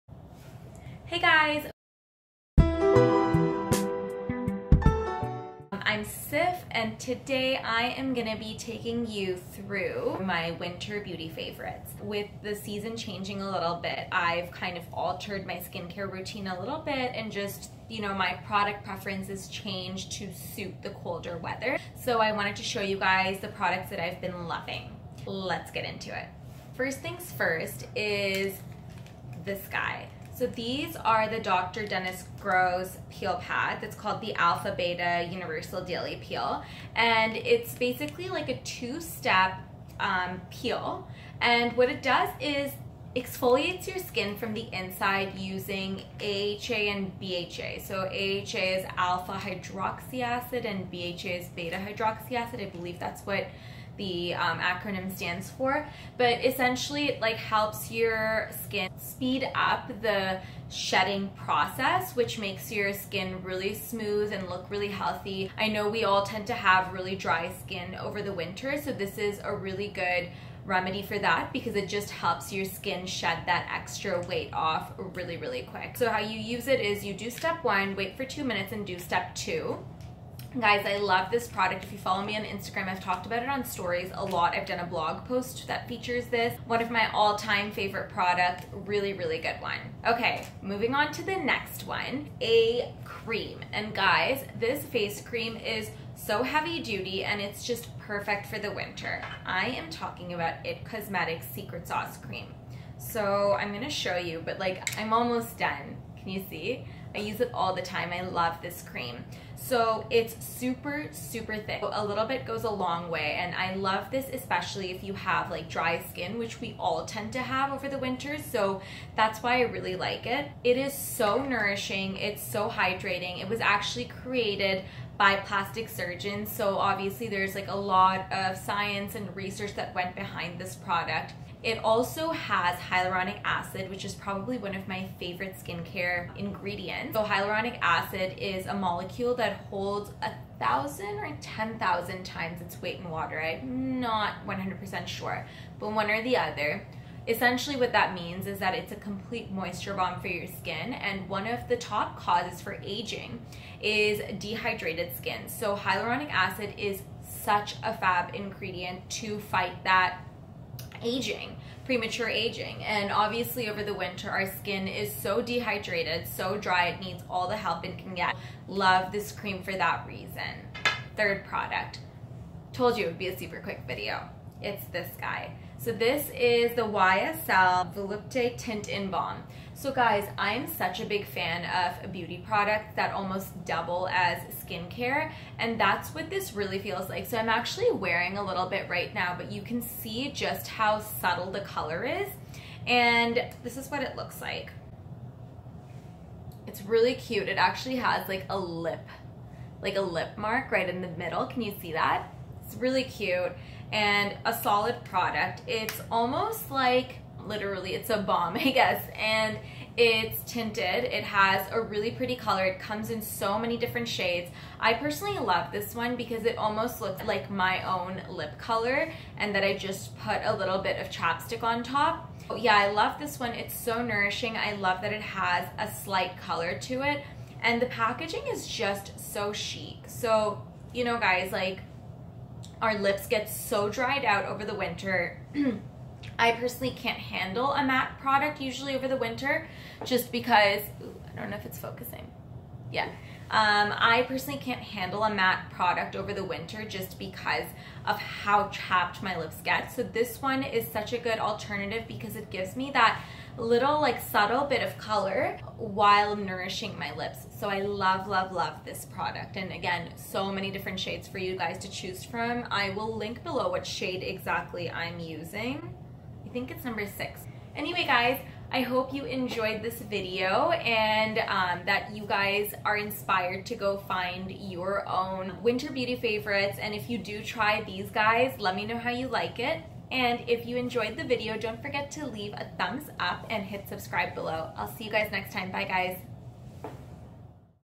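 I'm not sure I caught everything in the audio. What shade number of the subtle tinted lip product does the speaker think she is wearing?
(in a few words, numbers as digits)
6.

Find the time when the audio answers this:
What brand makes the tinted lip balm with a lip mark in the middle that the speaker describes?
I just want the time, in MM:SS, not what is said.
02:56.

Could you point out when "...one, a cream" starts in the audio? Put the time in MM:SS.
01:31.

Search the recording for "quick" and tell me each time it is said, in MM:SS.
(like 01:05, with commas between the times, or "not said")
01:15, 02:53.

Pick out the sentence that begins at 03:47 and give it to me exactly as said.
And the packaging is just so chic.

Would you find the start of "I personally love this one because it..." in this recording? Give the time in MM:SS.
03:34.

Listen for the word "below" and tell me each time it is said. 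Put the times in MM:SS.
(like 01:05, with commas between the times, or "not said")
04:23, 04:44.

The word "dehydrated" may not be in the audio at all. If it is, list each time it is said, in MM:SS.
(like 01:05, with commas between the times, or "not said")
02:34, 02:45.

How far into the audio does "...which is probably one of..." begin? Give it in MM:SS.
02:13.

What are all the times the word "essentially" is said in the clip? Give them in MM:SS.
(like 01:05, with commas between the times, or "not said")
00:56, 02:27.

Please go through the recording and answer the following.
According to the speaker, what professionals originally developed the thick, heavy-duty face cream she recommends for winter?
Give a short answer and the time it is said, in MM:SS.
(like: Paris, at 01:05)
Plastic surgeons, at 02:05.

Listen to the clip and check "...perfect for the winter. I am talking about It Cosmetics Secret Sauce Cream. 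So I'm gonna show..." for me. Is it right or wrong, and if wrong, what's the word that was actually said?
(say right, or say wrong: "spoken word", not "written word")
right.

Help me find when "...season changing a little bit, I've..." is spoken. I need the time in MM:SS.
00:12.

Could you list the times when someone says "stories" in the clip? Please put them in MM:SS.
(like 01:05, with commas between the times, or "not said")
01:23.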